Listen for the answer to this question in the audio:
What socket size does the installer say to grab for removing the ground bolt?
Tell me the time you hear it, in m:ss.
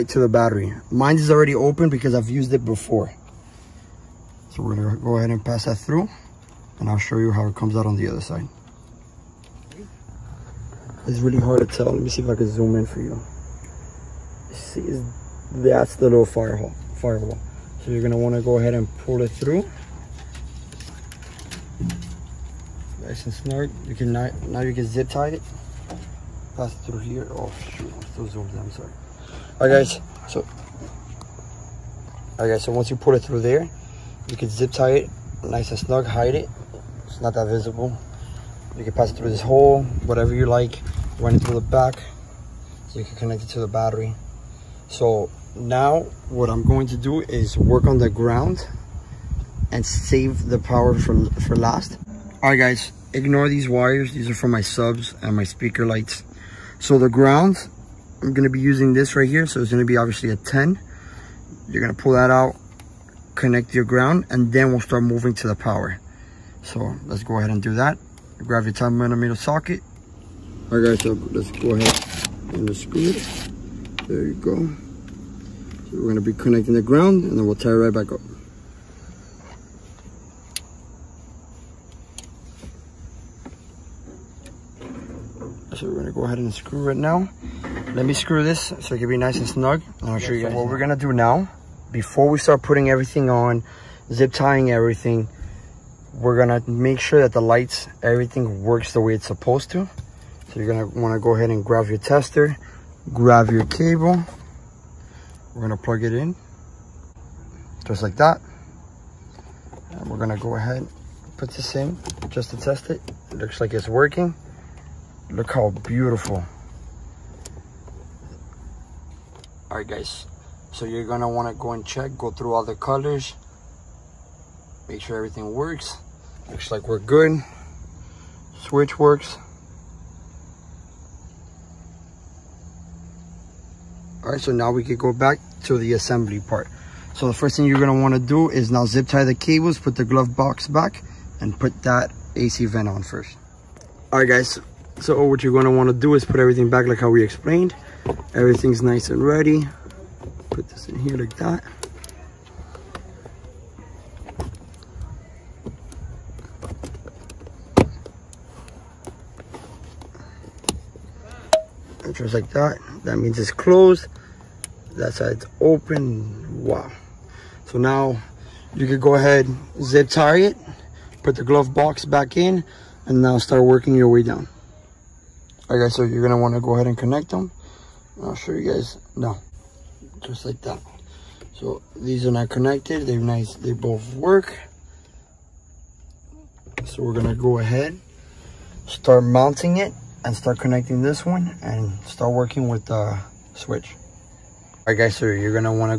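1:08.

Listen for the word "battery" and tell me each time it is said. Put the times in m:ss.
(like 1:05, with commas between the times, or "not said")
0:00, 0:43.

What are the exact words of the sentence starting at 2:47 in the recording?
So now you can go ahead, zip tie it, put the glove box back in, and now start working your way down.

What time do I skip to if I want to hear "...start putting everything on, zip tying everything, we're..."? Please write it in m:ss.
1:32.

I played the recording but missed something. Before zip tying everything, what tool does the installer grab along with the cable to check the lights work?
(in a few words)
tester.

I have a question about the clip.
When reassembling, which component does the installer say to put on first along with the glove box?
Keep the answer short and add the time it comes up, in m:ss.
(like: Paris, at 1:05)
AC vent, at 2:22.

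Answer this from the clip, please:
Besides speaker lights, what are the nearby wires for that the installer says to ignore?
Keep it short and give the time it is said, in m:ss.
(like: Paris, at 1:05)
subs, at 0:54.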